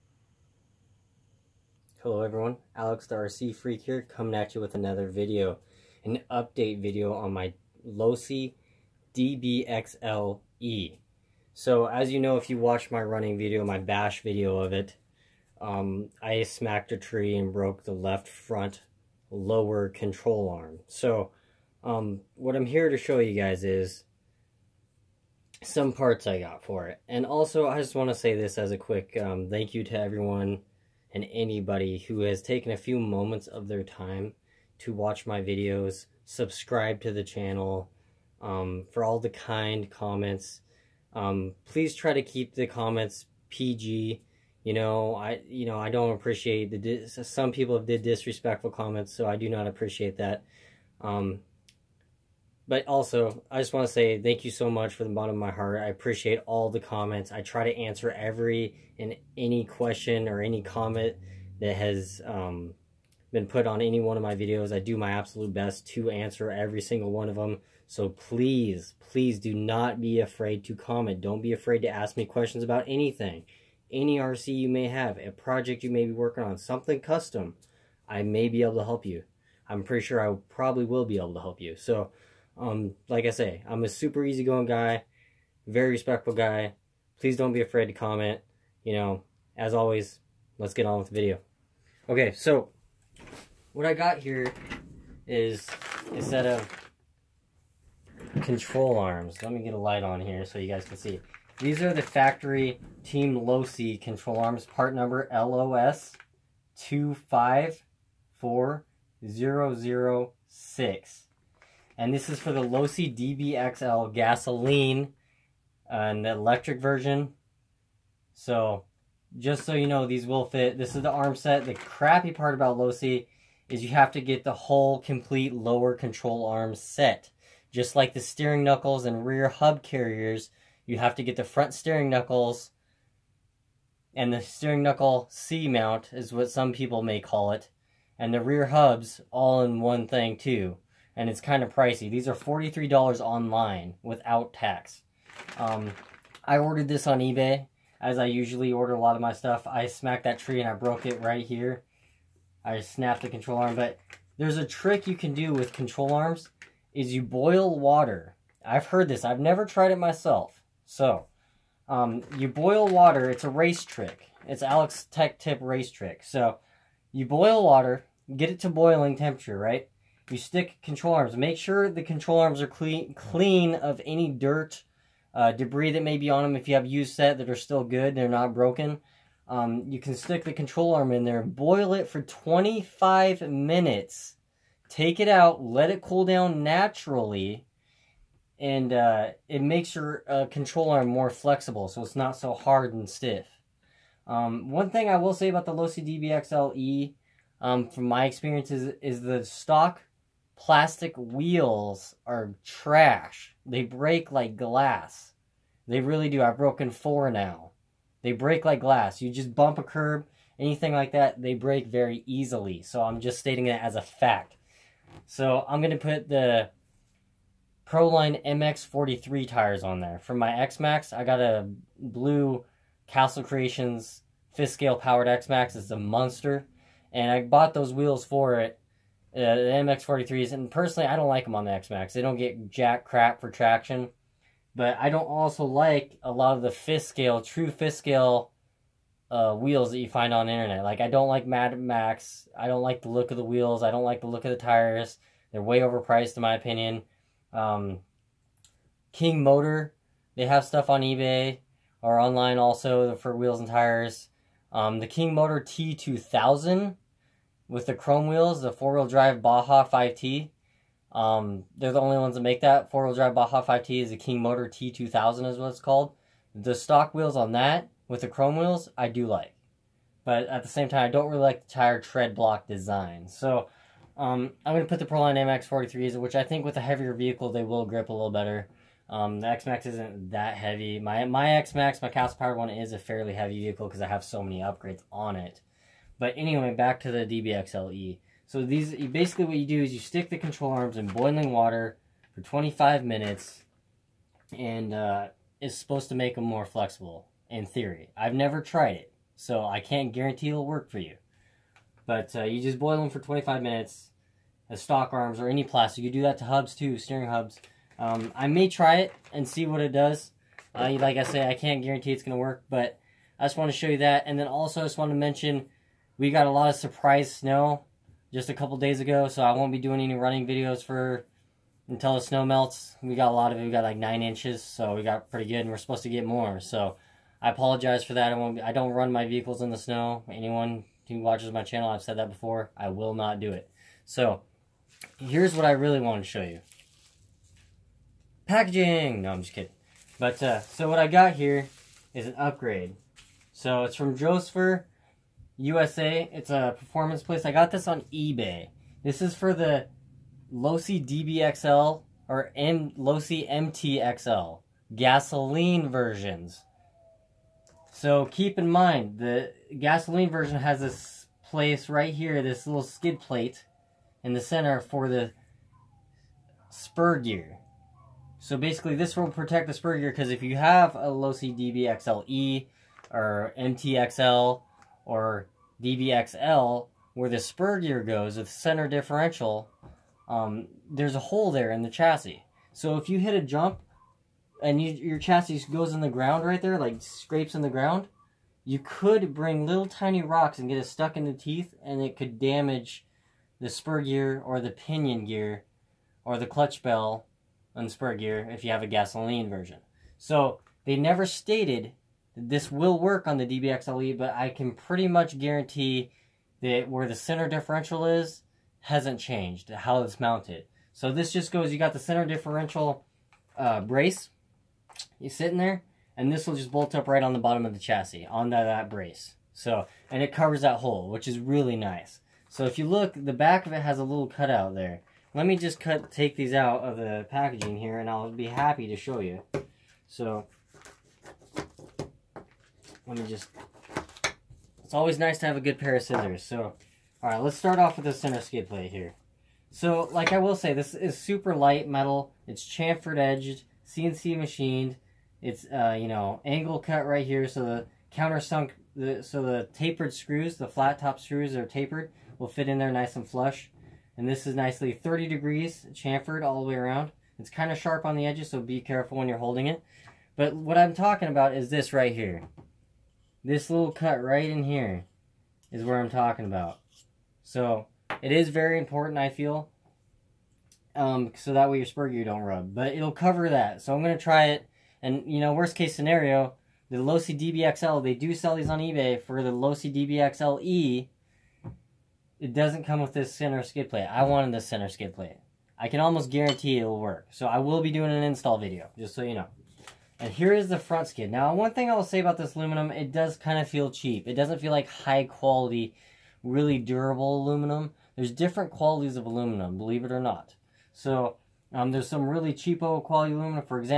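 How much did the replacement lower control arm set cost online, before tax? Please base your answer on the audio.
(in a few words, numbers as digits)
$43.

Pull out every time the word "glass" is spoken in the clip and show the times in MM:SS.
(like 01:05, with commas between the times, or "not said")
03:24, 03:28.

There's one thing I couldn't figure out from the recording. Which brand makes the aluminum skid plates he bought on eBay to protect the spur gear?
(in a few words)
Josfer USA.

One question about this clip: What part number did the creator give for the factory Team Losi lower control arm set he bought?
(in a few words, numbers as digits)
LOS 254006.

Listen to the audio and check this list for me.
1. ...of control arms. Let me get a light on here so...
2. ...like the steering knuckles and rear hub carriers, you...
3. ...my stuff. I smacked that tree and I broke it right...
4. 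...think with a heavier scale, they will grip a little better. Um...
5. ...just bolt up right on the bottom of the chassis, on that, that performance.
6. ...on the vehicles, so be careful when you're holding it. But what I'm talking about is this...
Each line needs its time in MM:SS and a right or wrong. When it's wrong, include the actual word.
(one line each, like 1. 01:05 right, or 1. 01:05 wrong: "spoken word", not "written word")
1. 01:36 right
2. 02:07 right
3. 02:29 right
4. 04:36 wrong: "vehicle", not "scale"
5. 06:56 wrong: "brace", not "performance"
6. 07:38 wrong: "edges", not "vehicles".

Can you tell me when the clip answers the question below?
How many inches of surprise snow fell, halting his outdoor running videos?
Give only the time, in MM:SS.
05:23.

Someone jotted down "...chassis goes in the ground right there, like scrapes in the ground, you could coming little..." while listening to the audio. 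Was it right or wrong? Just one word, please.
wrong.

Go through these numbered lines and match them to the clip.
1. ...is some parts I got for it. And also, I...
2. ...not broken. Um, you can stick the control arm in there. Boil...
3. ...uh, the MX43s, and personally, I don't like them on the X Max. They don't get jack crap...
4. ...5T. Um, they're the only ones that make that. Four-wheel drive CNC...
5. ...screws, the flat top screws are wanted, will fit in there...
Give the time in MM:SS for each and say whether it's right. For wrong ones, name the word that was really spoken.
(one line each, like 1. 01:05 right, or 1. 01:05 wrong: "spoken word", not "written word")
1. 00:23 right
2. 02:58 right
3. 03:49 right
4. 04:19 wrong: "Baja", not "CNC"
5. 07:30 wrong: "tapered", not "wanted".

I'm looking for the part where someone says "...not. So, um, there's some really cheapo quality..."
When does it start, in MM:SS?
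08:20.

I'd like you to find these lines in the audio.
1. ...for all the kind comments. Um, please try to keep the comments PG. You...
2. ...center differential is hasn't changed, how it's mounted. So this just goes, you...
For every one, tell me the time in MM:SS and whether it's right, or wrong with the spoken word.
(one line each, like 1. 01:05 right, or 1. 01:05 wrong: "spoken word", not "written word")
1. 00:38 right
2. 06:47 right.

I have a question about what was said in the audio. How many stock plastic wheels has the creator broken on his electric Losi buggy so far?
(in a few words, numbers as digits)
4.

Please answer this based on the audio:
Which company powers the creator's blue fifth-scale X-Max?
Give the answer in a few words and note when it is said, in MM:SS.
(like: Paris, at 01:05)
Castle Creations, at 03:43.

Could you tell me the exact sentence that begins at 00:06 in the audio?
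An update video on my Losi DBXLE.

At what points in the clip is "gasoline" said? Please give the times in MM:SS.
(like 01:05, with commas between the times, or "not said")
01:54, 05:54, 05:59, 06:38.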